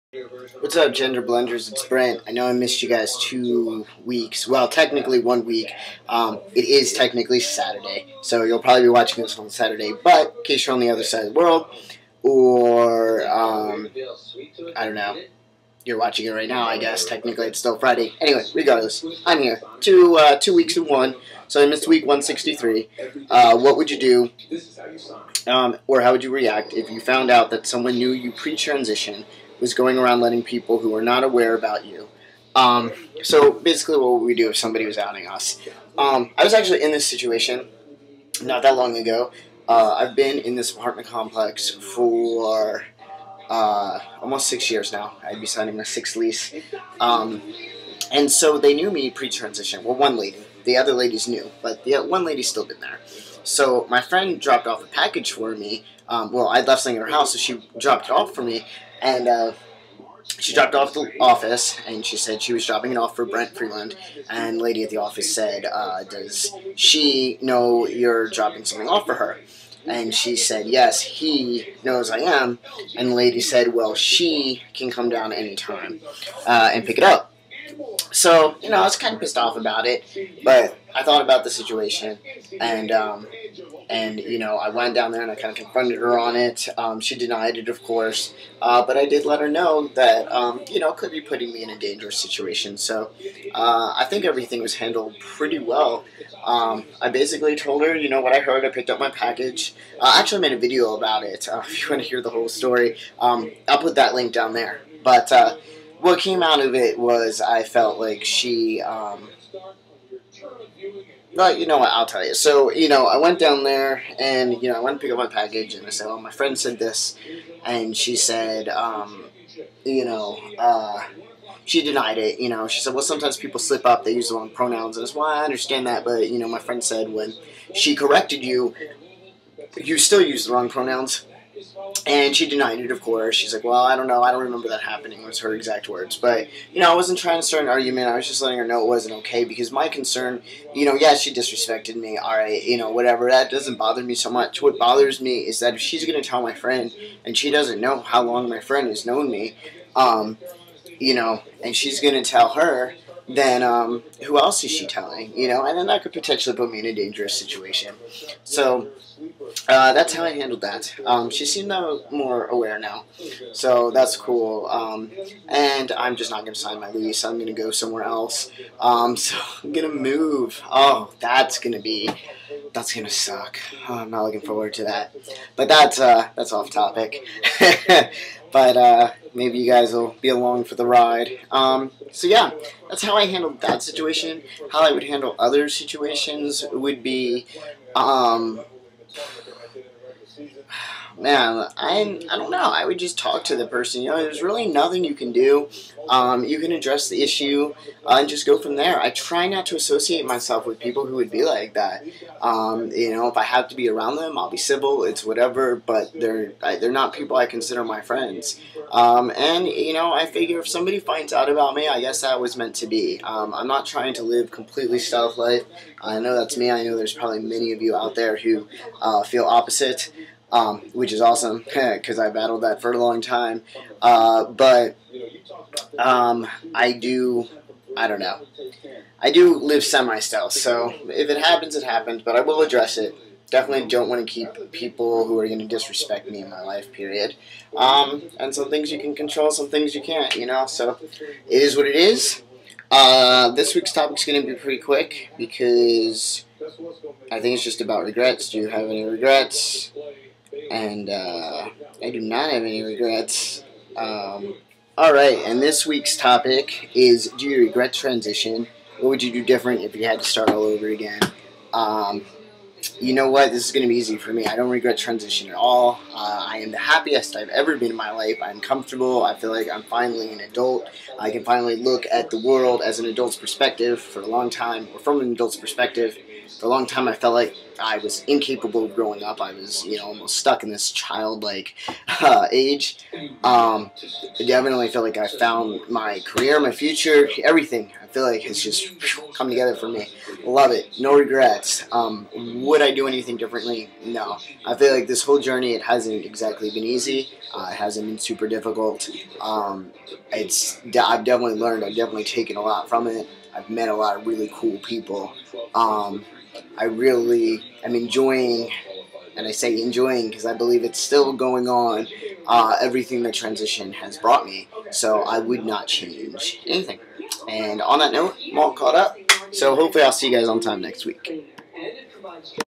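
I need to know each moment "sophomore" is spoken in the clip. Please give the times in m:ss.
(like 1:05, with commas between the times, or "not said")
not said.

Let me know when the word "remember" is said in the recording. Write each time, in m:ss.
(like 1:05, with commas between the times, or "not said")
2:14.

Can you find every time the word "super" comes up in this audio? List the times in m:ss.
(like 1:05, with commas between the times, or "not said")
4:58.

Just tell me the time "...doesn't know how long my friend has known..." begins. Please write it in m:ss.
2:27.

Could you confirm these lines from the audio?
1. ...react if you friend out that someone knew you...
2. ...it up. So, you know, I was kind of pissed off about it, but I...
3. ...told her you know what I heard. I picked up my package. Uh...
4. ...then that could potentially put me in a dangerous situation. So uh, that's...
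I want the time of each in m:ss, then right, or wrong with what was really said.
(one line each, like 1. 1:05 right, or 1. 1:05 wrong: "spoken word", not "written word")
1. 0:26 wrong: "found", not "friend"
2. 1:16 right
3. 1:37 right
4. 2:35 right.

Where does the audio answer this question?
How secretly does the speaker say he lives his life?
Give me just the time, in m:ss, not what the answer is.
3:49.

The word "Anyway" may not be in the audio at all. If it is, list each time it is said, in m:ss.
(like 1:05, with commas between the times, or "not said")
0:18.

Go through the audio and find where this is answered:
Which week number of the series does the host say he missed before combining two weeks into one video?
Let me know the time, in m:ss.
0:21.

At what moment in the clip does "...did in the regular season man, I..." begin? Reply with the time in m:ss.
3:09.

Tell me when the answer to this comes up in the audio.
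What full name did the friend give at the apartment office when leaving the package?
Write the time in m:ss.
1:03.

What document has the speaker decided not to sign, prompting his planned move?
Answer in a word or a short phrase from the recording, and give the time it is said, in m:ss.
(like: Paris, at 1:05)
my lease, at 2:46.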